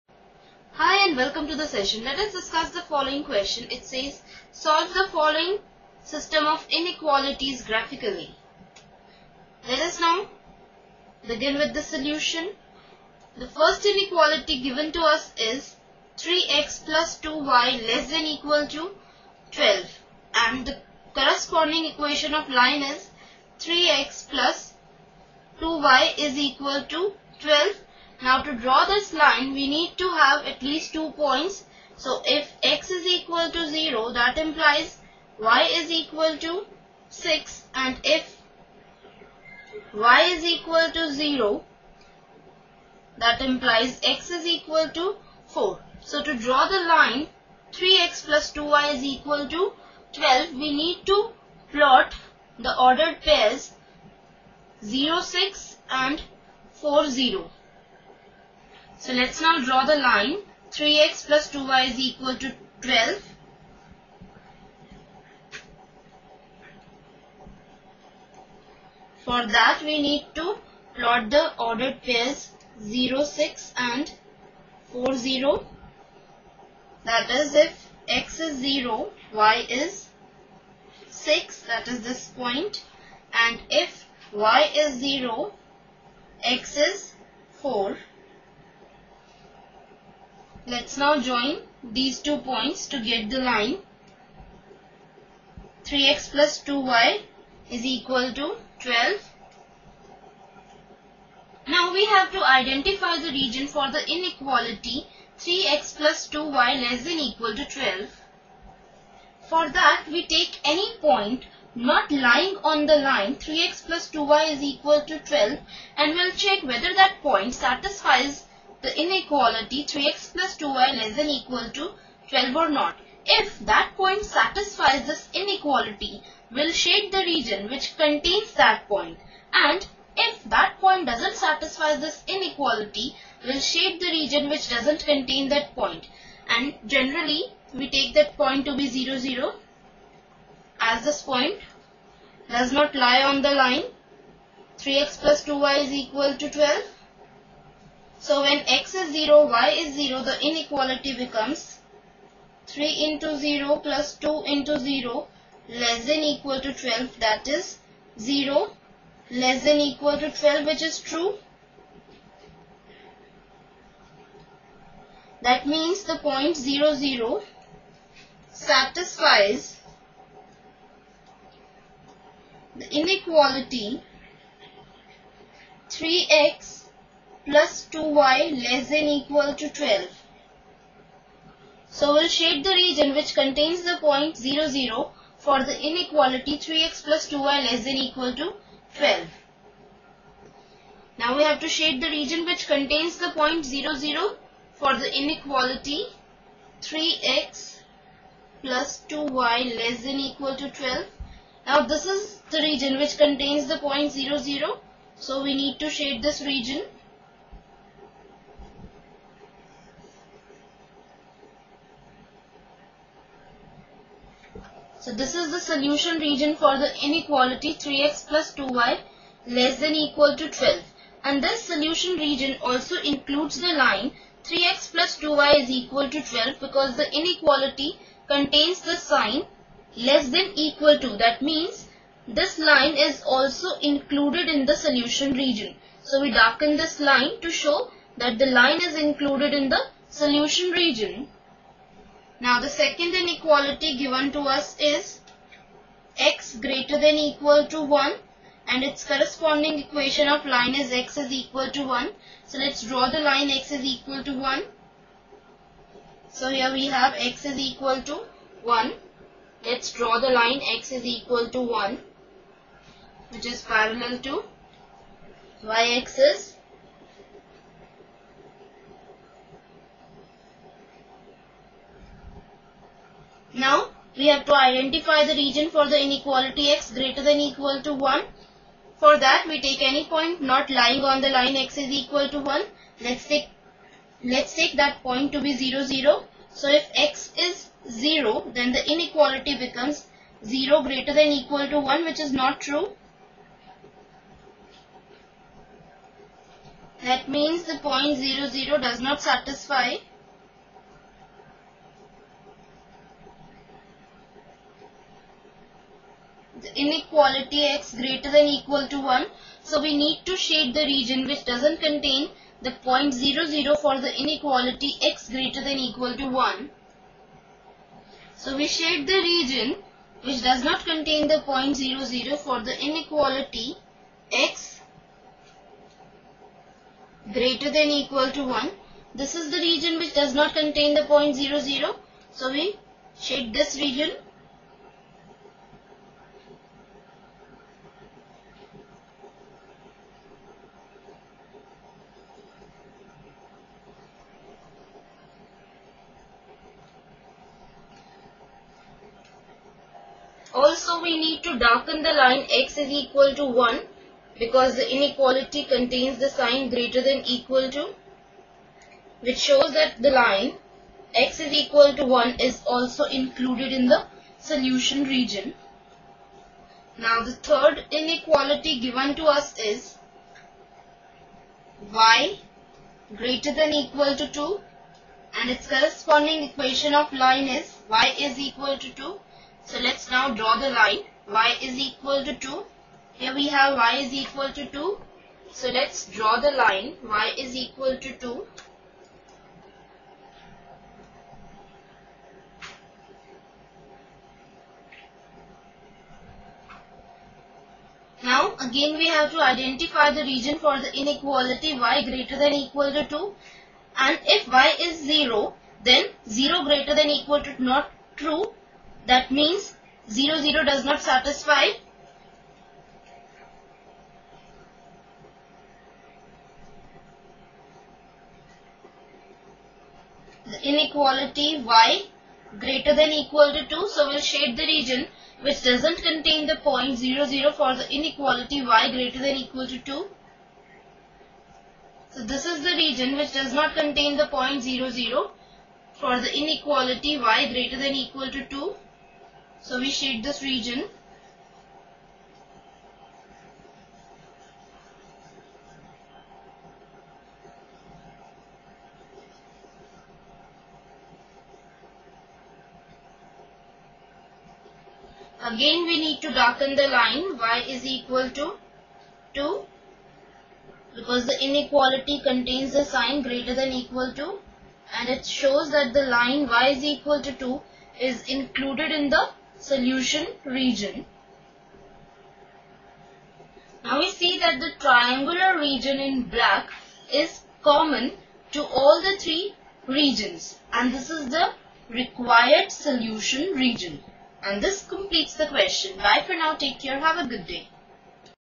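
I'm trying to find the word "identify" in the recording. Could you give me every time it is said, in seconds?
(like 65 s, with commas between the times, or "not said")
102 s, 274 s, 399 s.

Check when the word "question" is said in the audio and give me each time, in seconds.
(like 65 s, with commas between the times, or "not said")
3 s, 485 s.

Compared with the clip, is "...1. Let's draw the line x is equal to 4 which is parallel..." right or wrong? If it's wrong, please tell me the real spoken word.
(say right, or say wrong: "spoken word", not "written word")
wrong: "1", not "4".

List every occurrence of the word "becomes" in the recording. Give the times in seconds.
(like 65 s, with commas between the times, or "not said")
151 s, 289 s.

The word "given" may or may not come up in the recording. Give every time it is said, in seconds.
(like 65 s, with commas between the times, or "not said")
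14 s, 243 s, 368 s.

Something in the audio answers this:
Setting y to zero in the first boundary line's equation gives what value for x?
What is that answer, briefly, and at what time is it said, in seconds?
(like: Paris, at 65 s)
4, at 44 s.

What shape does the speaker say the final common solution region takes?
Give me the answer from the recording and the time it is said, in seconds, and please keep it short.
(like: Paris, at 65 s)
triangular, at 474 s.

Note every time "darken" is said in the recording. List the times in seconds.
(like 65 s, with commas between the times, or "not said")
236 s, 351 s, 456 s.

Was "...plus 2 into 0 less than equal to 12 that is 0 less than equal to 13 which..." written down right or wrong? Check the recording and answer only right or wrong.
wrong.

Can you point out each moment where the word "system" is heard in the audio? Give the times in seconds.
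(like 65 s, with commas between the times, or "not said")
6 s.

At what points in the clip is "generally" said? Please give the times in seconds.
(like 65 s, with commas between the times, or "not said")
136 s.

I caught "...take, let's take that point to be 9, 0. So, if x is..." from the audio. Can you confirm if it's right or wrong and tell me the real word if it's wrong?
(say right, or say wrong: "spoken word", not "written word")
wrong: "0", not "9".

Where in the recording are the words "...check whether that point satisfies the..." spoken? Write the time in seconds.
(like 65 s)
116 s.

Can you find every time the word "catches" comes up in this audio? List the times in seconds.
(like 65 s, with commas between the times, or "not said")
not said.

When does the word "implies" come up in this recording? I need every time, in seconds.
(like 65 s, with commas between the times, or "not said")
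34 s, 43 s.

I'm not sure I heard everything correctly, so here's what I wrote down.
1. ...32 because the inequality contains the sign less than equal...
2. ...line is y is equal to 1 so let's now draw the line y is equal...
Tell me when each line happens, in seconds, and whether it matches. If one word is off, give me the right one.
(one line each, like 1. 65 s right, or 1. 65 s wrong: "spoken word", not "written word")
1. 226 s wrong: "12", not "32"
2. 377 s wrong: "2", not "1".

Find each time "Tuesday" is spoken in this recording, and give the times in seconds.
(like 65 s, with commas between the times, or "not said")
not said.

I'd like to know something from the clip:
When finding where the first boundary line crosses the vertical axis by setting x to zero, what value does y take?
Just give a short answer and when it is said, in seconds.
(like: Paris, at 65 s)
6, at 35 s.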